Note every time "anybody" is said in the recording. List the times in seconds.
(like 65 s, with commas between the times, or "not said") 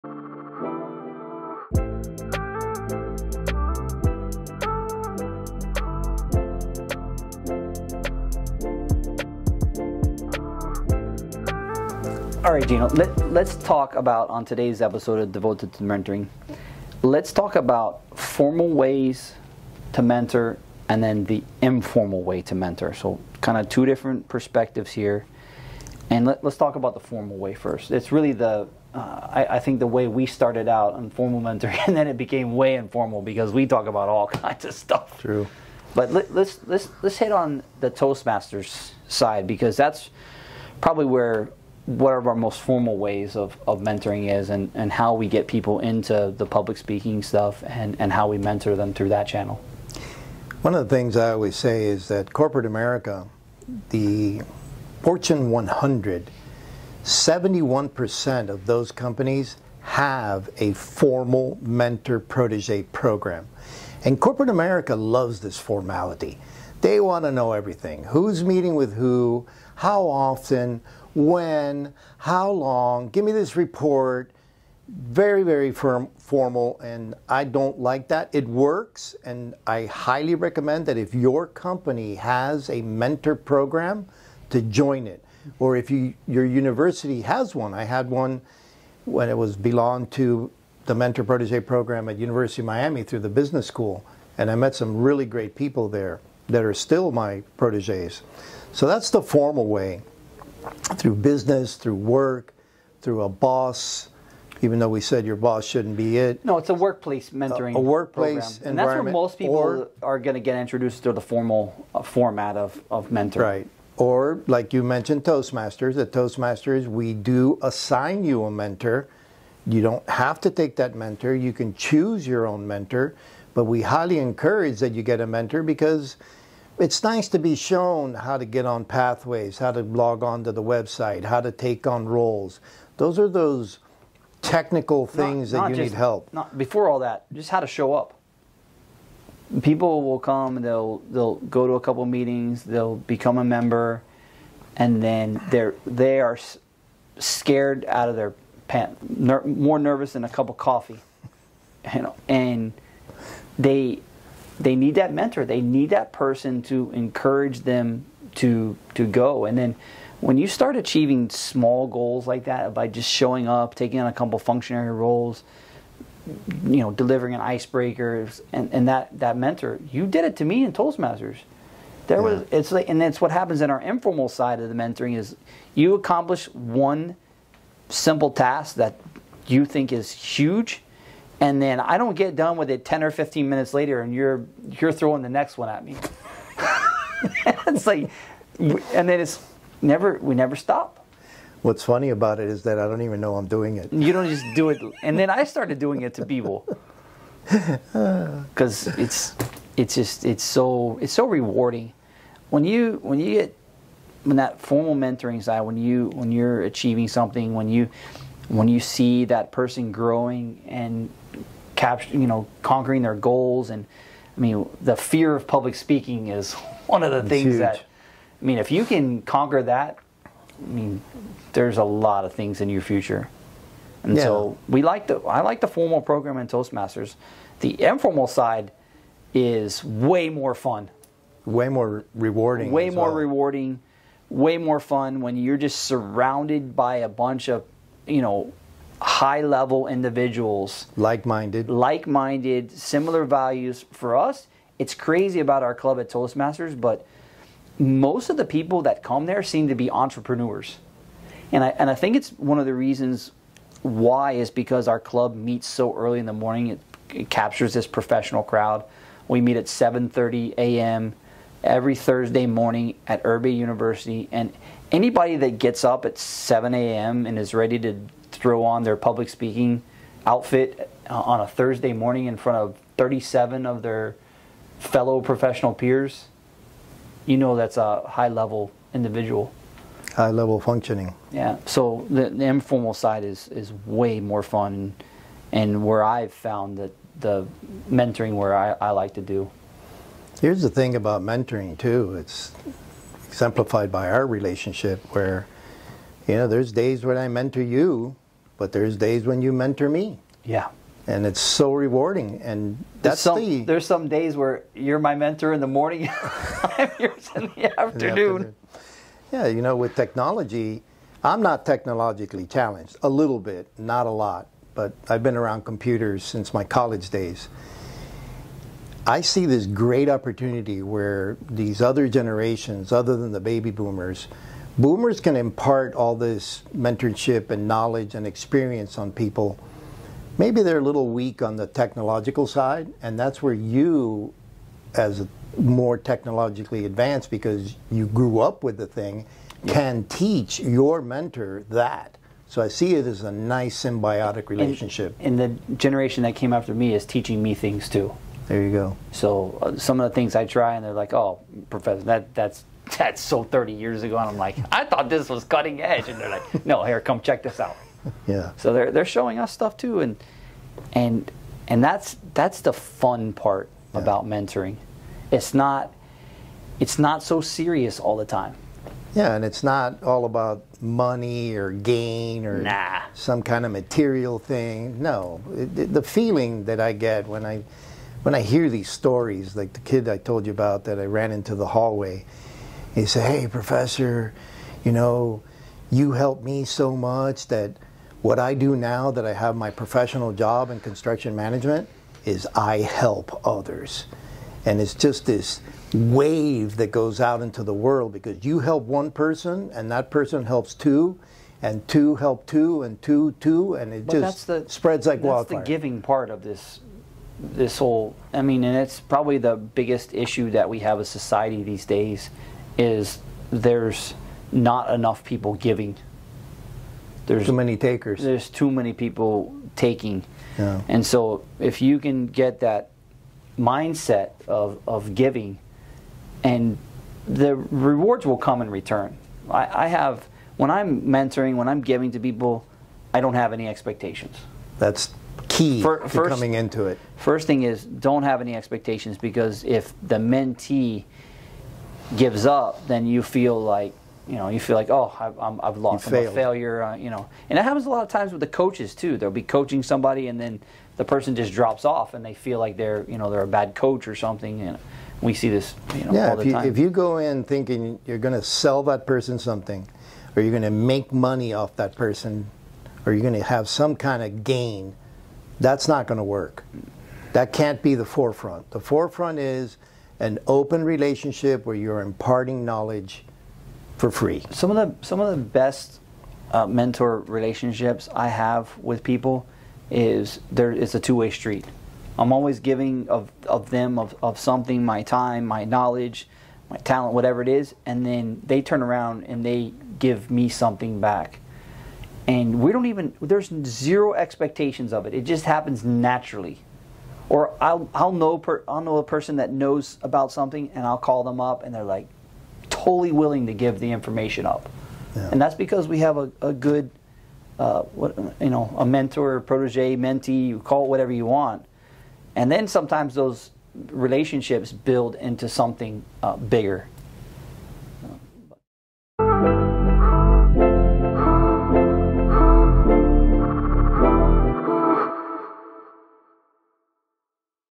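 264 s.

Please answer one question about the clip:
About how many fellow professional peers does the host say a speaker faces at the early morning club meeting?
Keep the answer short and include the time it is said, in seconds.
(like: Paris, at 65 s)
37, at 272 s.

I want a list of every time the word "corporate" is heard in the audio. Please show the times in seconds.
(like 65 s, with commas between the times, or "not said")
52 s, 64 s.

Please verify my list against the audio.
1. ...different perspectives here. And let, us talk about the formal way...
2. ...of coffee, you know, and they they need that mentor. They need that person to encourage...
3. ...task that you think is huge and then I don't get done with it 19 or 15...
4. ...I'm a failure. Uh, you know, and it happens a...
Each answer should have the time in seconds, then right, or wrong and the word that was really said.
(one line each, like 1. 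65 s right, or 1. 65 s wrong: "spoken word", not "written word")
1. 23 s right
2. 150 s right
3. 178 s wrong: "10", not "19"
4. 446 s right.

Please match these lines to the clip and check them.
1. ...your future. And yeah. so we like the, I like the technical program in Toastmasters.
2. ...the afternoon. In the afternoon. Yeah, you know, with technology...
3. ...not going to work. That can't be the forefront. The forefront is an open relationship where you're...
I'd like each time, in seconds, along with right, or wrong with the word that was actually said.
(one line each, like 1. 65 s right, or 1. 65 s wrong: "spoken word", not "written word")
1. 222 s wrong: "formal", not "technical"
2. 307 s right
3. 465 s right.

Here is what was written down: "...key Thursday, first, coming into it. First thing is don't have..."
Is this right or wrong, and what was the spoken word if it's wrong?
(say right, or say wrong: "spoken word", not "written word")
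wrong: "For", not "Thursday".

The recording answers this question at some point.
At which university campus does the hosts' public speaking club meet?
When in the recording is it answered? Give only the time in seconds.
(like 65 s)
263 s.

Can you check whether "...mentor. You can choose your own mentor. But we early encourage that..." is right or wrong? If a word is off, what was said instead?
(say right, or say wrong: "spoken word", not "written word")
wrong: "highly", not "early".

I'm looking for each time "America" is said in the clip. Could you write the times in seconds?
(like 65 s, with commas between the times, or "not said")
52 s, 64 s.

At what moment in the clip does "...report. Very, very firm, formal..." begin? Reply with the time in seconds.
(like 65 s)
73 s.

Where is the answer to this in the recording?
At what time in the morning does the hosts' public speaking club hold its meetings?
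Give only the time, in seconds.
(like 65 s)
259 s.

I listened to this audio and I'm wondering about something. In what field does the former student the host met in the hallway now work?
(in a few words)
Construction management.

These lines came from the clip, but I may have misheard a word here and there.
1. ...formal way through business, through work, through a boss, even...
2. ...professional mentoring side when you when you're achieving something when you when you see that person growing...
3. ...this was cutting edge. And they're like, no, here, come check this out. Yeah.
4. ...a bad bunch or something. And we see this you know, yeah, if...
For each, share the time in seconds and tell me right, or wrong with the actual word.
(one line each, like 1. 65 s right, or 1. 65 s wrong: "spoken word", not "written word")
1. 99 s right
2. 204 s wrong: "formal", not "professional"
3. 355 s right
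4. 453 s wrong: "coach", not "bunch".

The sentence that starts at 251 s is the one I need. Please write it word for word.
And I, and I think it's one of the reasons why is because our club meets so early in the morning.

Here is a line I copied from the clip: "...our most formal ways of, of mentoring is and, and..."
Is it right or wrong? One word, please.
right.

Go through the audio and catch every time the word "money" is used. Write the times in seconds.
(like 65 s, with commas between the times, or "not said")
370 s, 461 s.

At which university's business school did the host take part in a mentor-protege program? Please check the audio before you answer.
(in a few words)
University of Miami.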